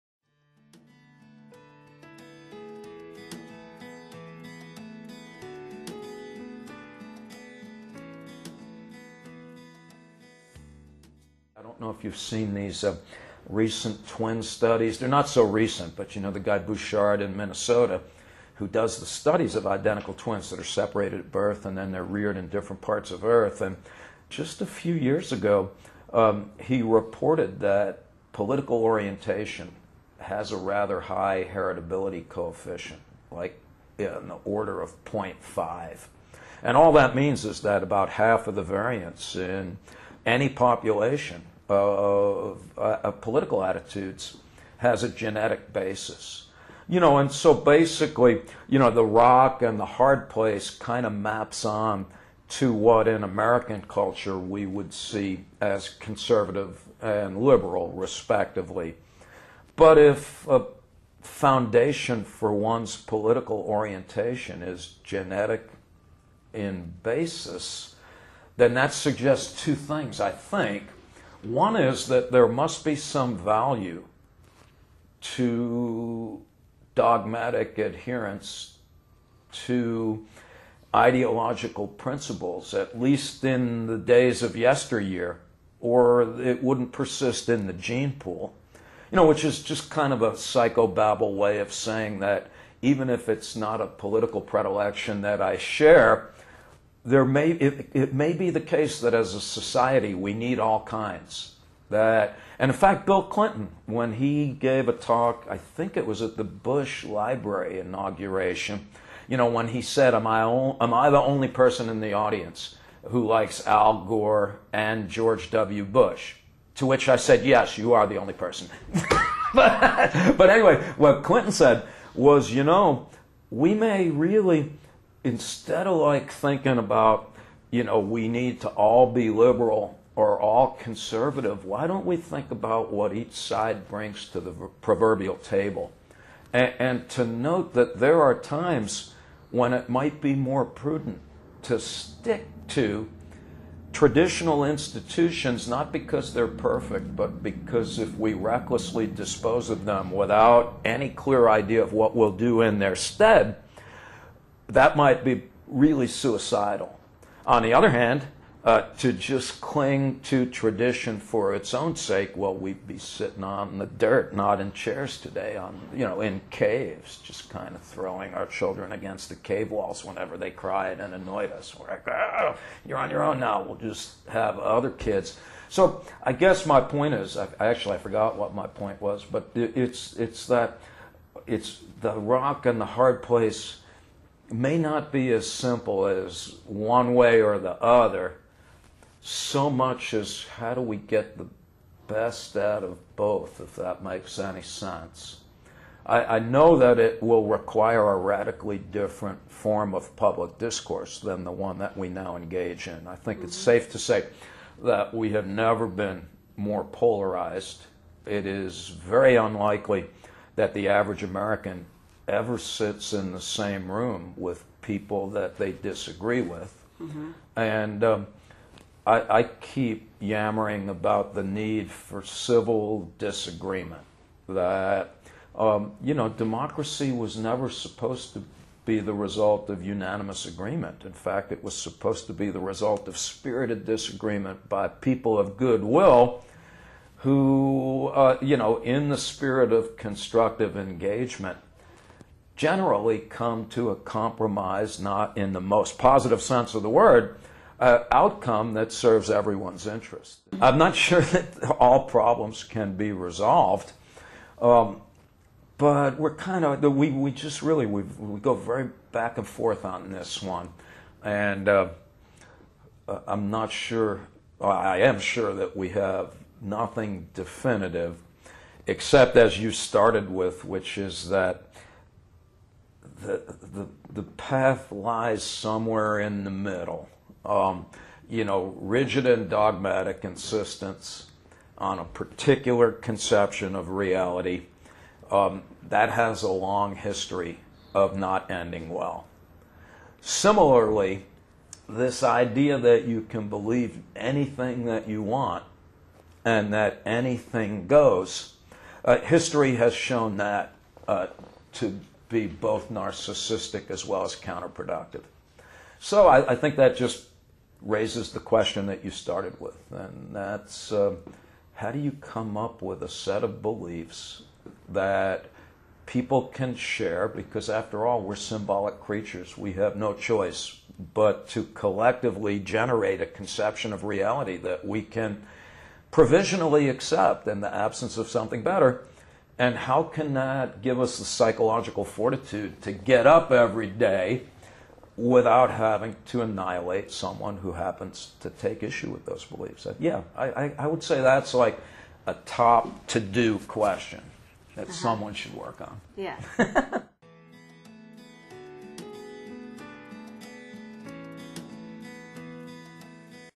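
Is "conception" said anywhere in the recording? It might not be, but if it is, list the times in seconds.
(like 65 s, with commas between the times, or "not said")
282 s, 323 s.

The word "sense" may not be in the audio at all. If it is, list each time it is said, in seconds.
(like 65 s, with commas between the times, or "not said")
194 s, 246 s.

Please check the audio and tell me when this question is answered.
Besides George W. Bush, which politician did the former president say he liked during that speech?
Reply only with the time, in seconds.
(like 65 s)
113 s.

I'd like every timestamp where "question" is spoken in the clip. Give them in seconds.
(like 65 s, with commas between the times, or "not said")
308 s, 343 s.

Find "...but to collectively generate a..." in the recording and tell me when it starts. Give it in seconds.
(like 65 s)
321 s.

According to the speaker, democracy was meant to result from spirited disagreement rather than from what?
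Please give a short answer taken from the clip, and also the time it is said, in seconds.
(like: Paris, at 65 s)
unanimous agreement, at 229 s.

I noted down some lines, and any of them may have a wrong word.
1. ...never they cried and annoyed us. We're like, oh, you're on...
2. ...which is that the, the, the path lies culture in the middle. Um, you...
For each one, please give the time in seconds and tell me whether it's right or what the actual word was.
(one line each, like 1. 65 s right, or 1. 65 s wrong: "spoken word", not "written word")
1. 170 s wrong: "whenever", not "never"
2. 270 s wrong: "somewhere", not "culture".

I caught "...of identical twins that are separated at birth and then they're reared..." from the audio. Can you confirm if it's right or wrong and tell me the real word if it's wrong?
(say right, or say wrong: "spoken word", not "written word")
right.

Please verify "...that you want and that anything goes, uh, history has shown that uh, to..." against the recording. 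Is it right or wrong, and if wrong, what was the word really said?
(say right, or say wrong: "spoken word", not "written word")
right.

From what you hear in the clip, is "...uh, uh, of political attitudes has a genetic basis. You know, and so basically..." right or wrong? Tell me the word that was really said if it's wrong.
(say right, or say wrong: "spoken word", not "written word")
right.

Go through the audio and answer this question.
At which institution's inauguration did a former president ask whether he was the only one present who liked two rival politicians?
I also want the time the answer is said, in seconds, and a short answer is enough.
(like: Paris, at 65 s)
Bush Library, at 106 s.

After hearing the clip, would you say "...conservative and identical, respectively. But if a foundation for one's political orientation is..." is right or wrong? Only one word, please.
wrong.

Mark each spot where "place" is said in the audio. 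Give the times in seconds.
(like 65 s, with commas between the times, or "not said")
50 s, 183 s.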